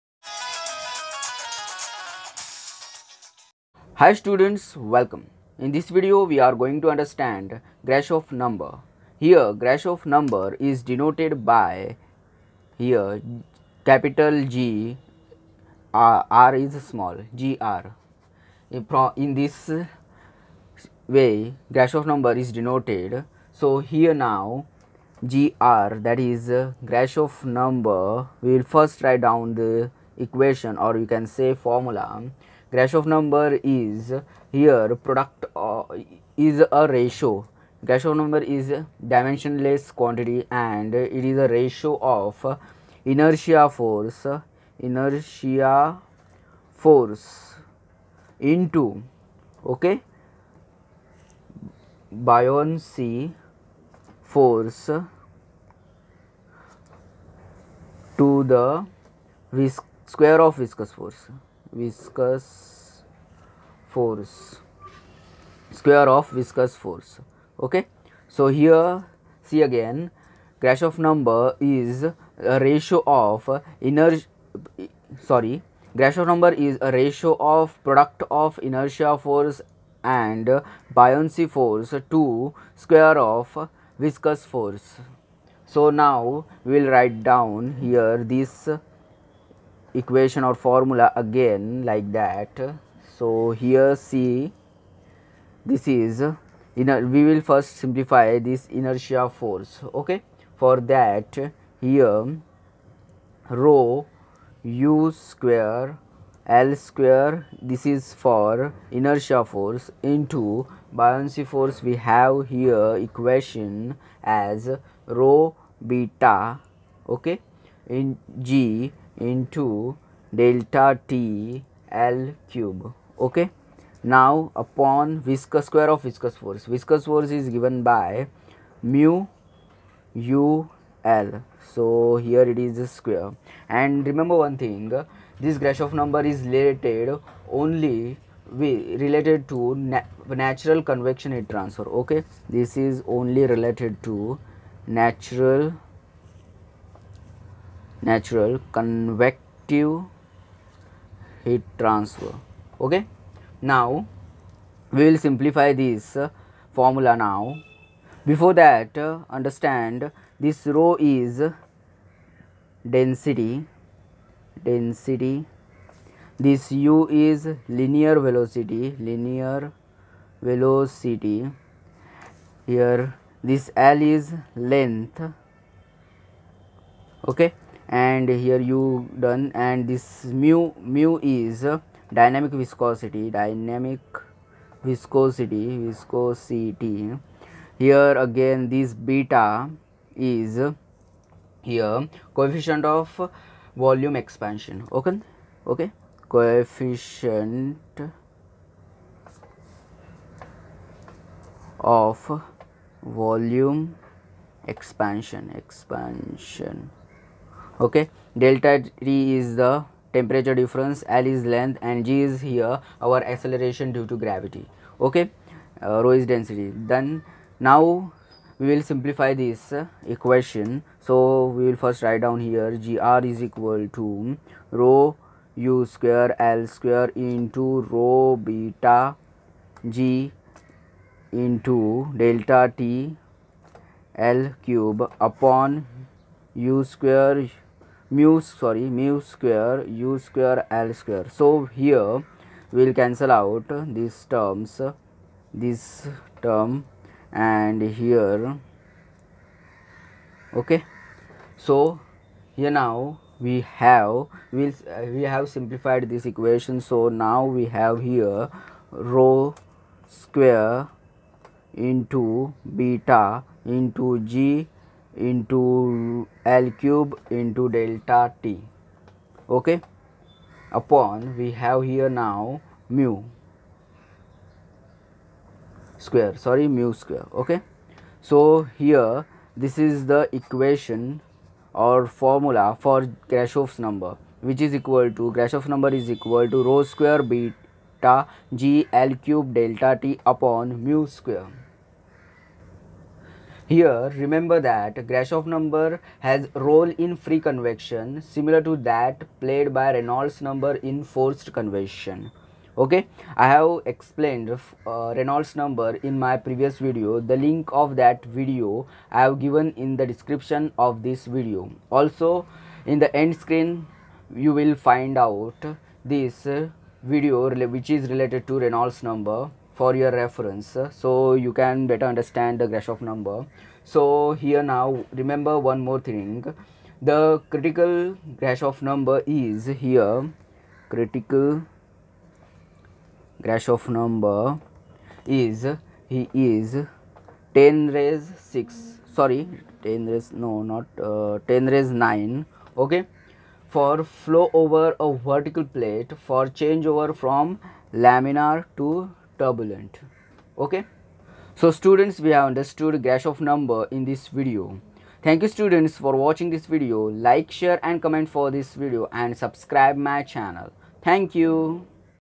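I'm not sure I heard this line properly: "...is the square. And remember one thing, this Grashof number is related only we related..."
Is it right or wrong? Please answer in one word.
right.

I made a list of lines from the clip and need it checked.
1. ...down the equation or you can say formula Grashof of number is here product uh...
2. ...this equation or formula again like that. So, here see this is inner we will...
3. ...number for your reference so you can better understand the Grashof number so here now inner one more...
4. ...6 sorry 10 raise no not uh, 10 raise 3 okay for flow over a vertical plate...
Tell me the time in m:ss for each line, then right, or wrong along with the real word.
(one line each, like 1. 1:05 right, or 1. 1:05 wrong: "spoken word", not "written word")
1. 0:29 right
2. 1:28 right
3. 5:19 wrong: "remember", not "inner"
4. 5:38 wrong: "9", not "3".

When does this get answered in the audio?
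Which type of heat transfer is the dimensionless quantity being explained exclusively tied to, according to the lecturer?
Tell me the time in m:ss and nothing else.
2:28.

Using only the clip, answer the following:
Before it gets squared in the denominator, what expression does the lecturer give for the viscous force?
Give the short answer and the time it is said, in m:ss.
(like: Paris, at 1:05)
mu u L, at 2:08.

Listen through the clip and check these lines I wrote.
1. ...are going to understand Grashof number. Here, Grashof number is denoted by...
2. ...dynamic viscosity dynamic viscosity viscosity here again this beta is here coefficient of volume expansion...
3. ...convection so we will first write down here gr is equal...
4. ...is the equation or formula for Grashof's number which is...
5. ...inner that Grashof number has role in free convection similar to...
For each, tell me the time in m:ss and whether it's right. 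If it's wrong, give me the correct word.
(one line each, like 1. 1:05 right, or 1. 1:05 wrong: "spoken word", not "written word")
1. 0:06 right
2. 3:02 right
3. 3:40 wrong: "equation", not "convection"
4. 4:39 right
5. 4:54 wrong: "remember", not "inner".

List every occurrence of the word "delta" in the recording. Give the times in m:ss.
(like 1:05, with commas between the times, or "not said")
2:00, 3:28, 3:52, 4:27, 4:49.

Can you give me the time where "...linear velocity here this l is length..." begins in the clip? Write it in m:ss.
2:49.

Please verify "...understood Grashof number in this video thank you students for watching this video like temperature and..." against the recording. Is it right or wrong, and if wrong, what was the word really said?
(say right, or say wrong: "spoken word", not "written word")
wrong: "share", not "temperature".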